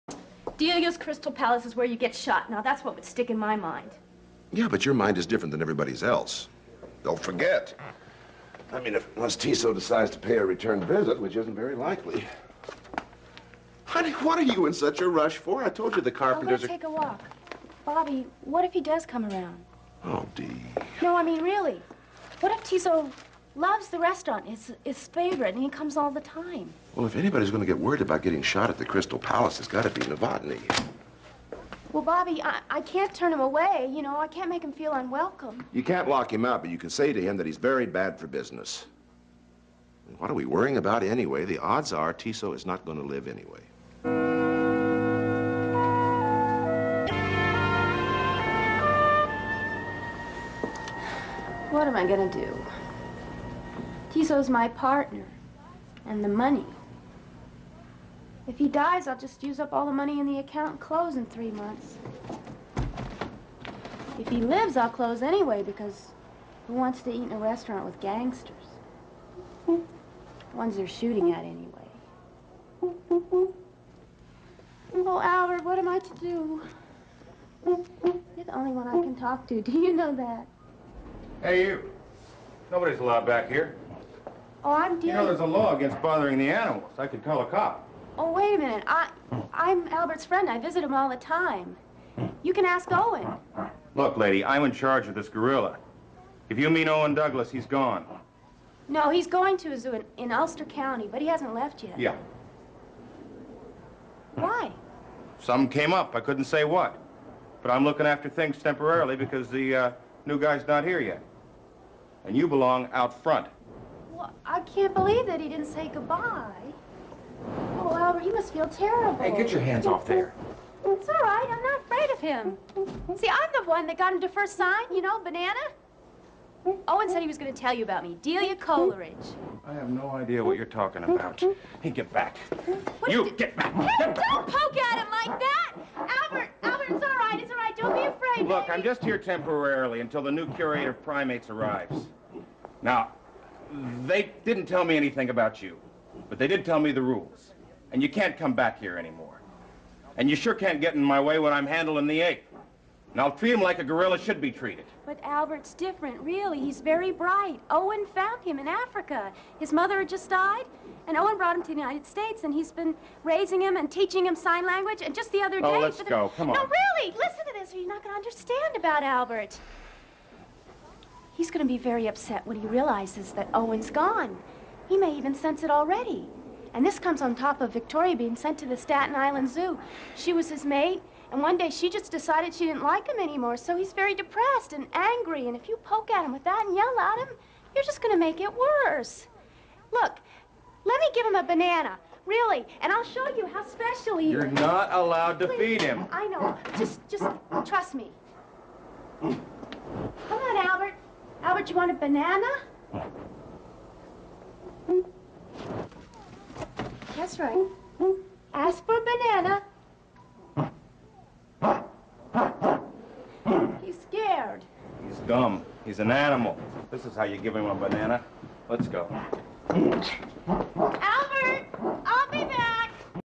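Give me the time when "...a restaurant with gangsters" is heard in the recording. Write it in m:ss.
1:07.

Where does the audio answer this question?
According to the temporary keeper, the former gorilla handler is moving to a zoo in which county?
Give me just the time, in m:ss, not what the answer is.
1:40.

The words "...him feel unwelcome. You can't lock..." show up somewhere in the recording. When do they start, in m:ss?
0:34.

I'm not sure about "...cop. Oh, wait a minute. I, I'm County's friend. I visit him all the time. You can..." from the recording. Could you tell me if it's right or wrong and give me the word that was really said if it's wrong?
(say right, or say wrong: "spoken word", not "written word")
wrong: "Albert", not "County".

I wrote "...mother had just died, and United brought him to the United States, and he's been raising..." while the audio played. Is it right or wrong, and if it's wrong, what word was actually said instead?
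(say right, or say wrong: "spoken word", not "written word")
wrong: "Owen", not "United".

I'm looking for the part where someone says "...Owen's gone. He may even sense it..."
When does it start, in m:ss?
2:53.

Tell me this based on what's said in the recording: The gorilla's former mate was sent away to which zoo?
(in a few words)
Staten Island Zoo.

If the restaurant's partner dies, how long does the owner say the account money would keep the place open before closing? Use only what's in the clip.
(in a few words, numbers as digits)
3 months.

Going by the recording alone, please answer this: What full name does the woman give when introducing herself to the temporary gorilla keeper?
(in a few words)
Delia Coleridge.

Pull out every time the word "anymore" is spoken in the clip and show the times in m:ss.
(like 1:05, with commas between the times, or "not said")
2:28, 3:03.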